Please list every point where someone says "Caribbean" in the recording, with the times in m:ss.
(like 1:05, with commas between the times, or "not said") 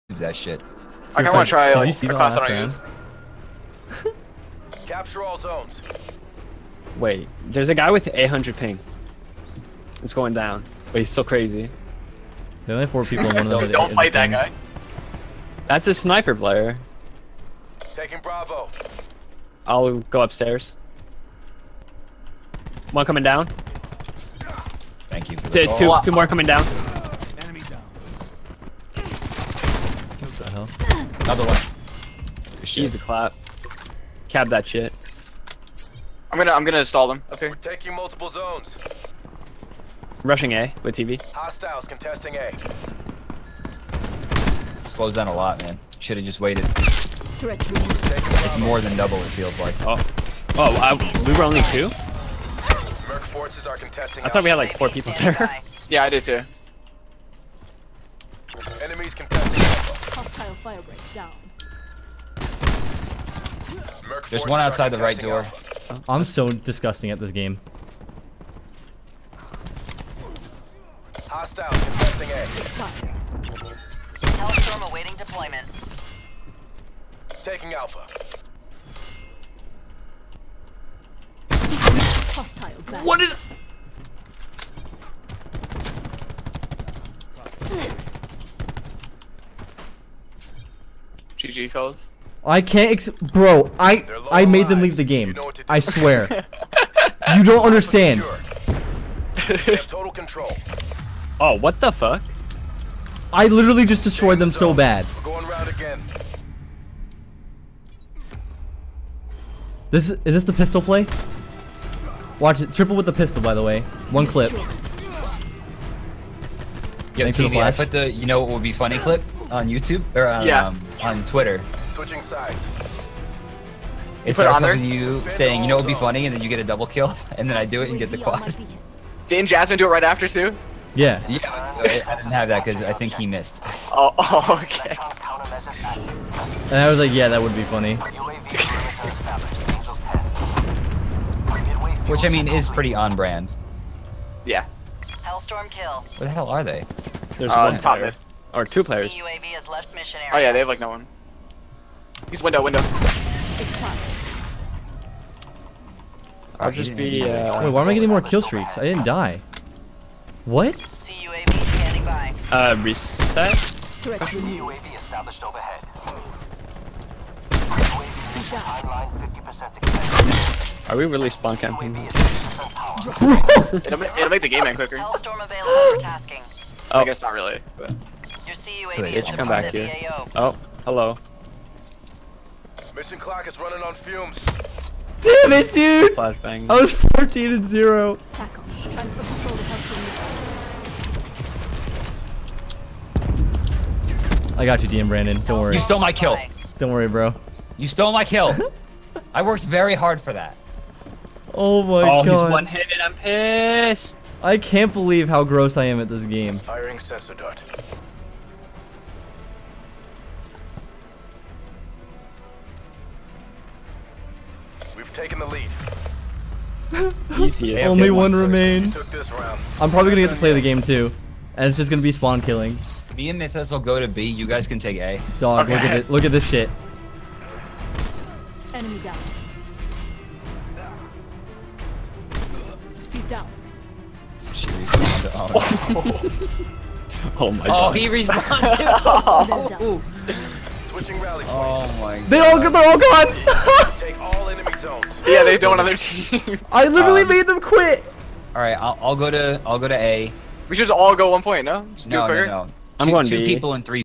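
not said.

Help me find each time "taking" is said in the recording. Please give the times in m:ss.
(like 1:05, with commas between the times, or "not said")
0:17, 0:37, 1:17.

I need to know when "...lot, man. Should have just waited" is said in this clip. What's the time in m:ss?
0:45.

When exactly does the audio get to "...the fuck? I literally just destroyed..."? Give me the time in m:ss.
1:41.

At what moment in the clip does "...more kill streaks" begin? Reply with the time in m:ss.
2:38.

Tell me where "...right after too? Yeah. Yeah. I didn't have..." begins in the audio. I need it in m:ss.
2:09.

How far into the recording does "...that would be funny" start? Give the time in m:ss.
2:17.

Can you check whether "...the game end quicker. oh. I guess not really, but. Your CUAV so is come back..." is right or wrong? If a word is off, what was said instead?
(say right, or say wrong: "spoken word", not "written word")
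right.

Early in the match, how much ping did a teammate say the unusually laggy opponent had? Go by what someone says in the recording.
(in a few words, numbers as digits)
800.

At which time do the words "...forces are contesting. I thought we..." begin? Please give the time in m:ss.
0:53.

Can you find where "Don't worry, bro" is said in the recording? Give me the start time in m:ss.
3:16.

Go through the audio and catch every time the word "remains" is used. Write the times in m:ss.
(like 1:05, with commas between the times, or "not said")
3:38.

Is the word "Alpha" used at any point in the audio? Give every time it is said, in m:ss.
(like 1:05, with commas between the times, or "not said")
1:17.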